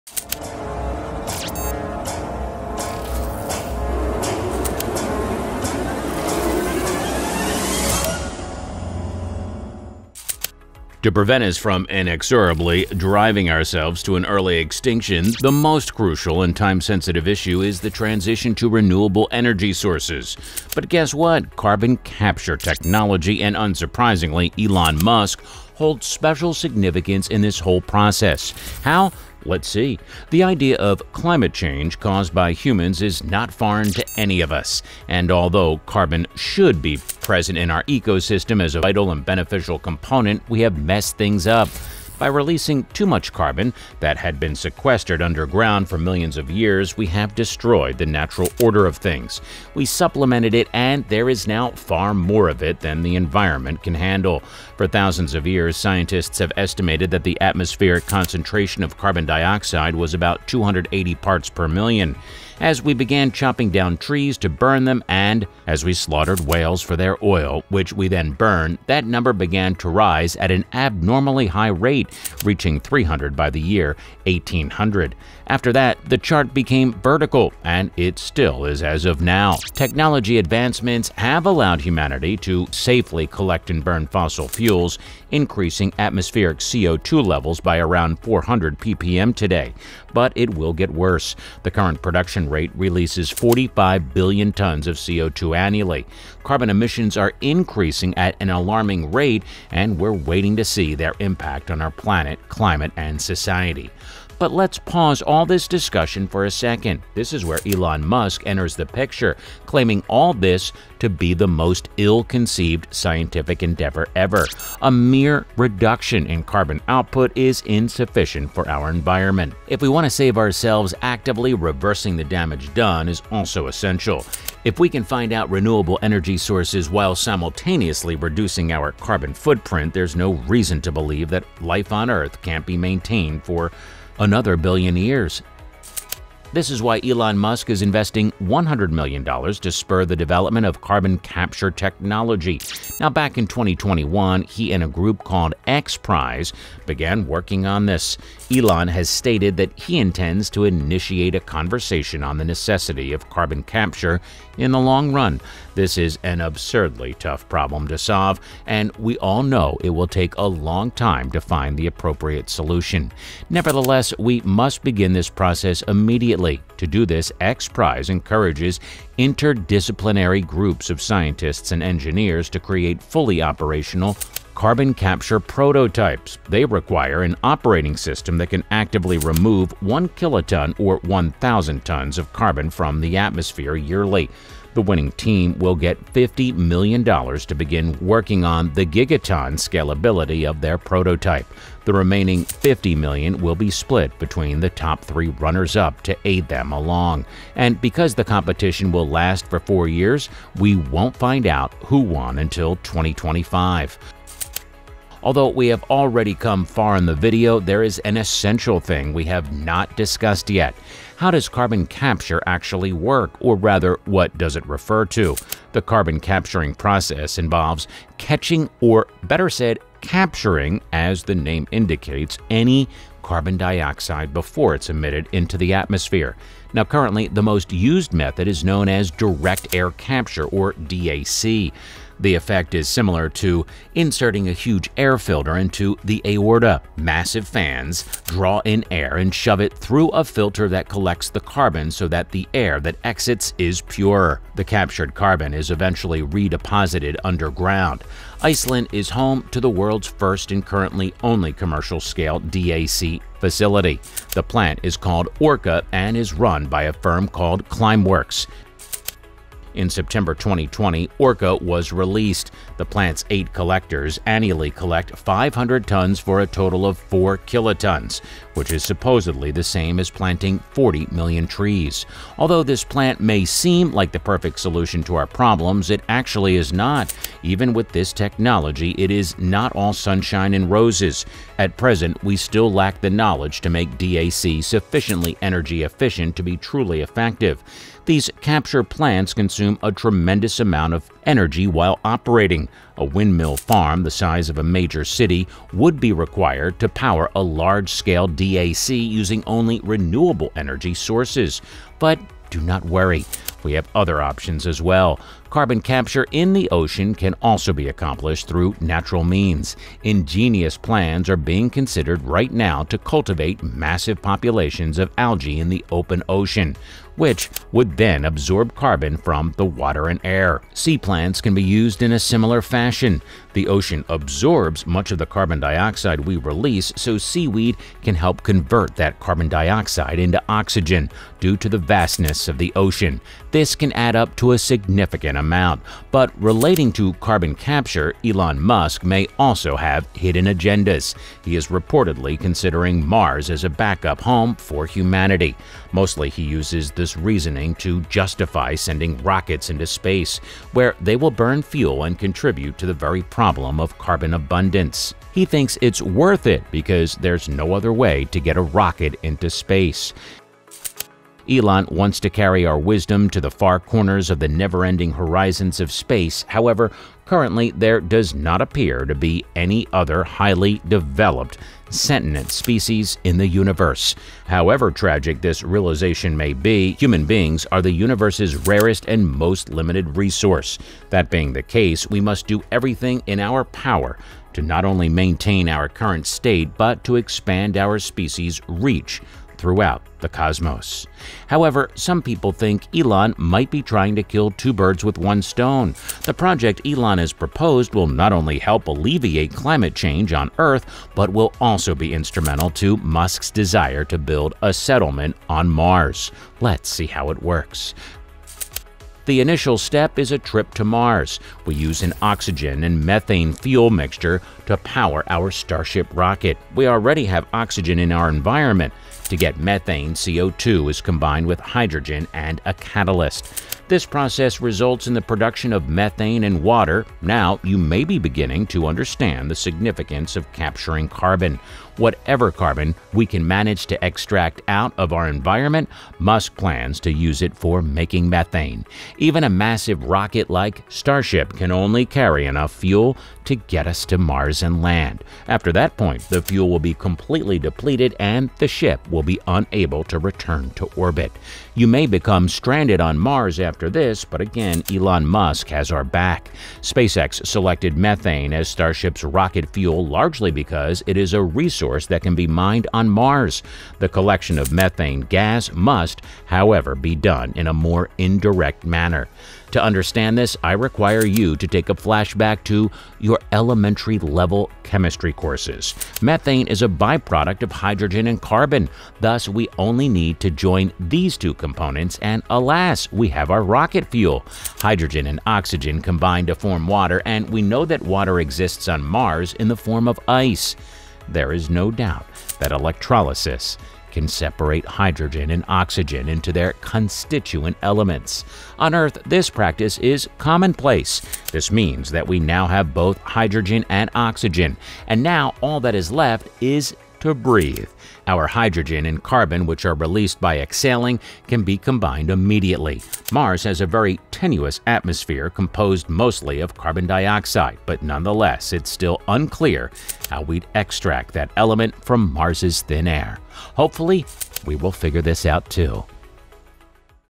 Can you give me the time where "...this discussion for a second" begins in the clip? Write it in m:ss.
1:45.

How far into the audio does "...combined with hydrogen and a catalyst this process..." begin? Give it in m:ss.
7:01.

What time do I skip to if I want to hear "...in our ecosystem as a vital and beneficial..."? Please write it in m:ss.
0:37.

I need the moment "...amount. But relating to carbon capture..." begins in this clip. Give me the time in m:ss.
5:35.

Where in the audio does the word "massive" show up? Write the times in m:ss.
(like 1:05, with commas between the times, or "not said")
3:56, 5:13, 7:19.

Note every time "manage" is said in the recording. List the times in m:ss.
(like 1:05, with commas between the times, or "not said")
7:13.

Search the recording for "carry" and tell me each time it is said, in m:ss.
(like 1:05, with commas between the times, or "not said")
6:02, 7:22.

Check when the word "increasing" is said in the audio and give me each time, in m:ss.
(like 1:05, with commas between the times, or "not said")
1:25, 1:37.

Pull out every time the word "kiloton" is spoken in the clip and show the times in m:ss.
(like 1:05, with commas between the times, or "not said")
3:00, 4:27.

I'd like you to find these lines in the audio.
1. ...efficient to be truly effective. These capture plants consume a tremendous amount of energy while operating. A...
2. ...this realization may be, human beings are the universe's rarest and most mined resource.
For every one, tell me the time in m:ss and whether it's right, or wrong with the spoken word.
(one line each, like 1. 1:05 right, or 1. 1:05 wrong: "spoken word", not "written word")
1. 4:45 right
2. 6:15 wrong: "limited", not "mined".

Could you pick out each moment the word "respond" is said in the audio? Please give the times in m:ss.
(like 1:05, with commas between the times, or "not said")
not said.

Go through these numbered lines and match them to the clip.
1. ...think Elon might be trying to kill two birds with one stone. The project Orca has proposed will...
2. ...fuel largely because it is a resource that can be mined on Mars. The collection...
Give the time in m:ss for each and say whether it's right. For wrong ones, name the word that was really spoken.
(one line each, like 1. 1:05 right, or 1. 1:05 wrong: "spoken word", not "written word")
1. 6:32 wrong: "Elon", not "Orca"
2. 7:39 right.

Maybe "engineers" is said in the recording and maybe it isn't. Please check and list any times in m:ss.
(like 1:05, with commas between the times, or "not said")
2:51.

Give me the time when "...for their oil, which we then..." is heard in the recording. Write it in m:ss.
1:06.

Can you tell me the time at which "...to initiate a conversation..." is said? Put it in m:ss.
2:30.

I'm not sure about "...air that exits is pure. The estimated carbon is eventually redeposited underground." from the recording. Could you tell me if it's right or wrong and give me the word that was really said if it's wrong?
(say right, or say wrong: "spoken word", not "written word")
wrong: "captured", not "estimated".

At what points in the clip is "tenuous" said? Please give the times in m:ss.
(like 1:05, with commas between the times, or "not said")
8:34.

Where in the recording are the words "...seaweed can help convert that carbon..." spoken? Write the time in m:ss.
5:27.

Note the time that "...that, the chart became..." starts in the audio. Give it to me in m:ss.
1:15.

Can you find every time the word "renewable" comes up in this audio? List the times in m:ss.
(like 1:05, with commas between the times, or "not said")
0:18, 2:05, 4:59.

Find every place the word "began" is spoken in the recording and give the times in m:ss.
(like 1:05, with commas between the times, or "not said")
1:02, 1:09, 2:26.